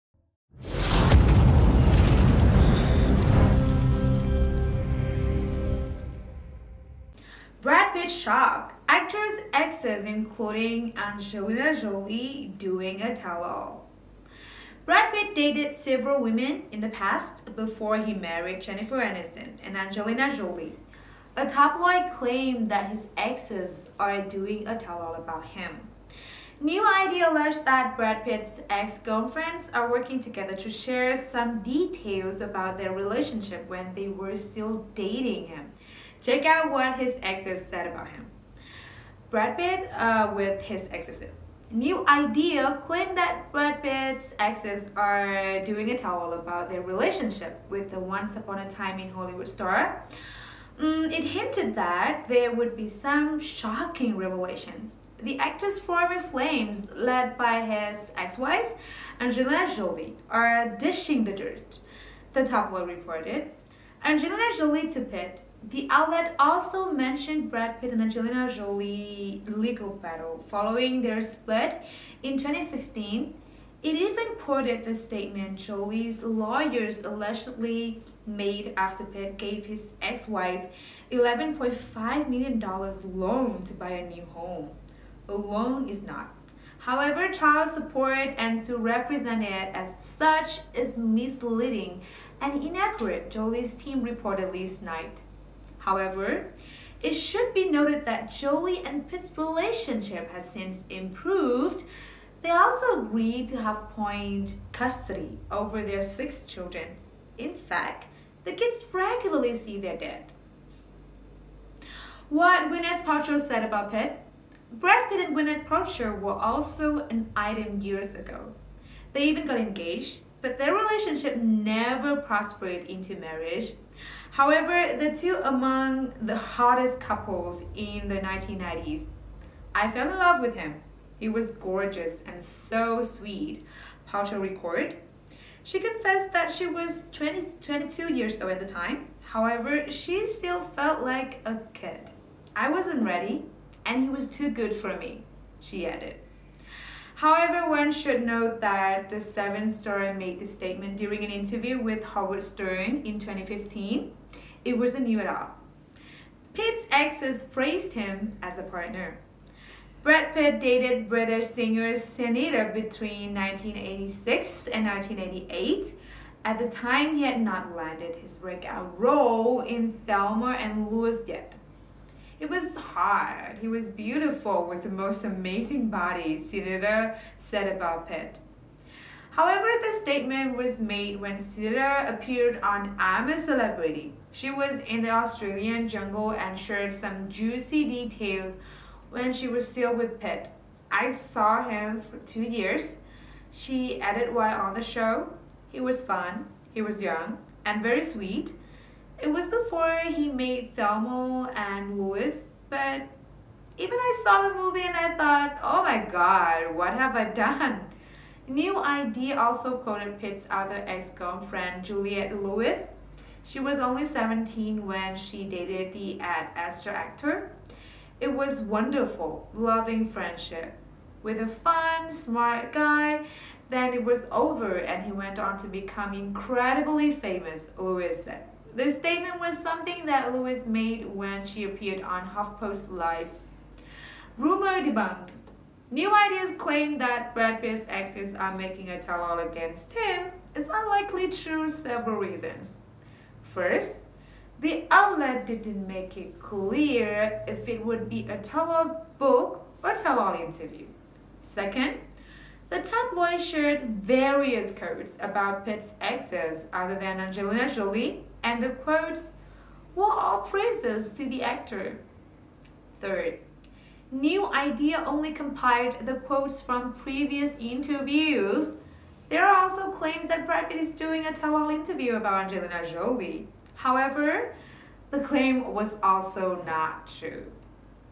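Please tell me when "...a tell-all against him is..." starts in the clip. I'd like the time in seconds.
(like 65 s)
238 s.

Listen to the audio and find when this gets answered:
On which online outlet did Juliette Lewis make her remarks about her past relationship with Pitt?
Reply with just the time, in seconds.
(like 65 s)
232 s.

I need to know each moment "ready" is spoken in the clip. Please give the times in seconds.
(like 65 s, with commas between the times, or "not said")
143 s.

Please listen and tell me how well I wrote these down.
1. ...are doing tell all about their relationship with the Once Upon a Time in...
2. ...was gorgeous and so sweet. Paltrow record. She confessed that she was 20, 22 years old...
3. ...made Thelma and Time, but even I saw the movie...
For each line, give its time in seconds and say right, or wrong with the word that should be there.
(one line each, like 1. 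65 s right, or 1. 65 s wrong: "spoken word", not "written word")
1. 44 s right
2. 131 s right
3. 200 s wrong: "Louise", not "Time".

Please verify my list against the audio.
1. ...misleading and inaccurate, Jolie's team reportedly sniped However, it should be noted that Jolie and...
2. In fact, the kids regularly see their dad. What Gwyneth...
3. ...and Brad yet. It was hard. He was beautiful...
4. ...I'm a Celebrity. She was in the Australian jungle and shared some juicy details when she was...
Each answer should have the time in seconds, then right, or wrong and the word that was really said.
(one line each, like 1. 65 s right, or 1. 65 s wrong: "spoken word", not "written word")
1. 90 s right
2. 107 s right
3. 170 s wrong: "Louise", not "Brad"
4. 182 s right.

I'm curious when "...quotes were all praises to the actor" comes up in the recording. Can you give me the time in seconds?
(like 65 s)
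258 s.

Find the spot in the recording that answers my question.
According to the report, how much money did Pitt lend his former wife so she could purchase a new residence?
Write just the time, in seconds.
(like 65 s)
81 s.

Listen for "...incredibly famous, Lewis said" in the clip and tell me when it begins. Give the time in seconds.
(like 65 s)
226 s.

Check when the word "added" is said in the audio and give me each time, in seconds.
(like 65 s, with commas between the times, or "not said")
145 s, 194 s.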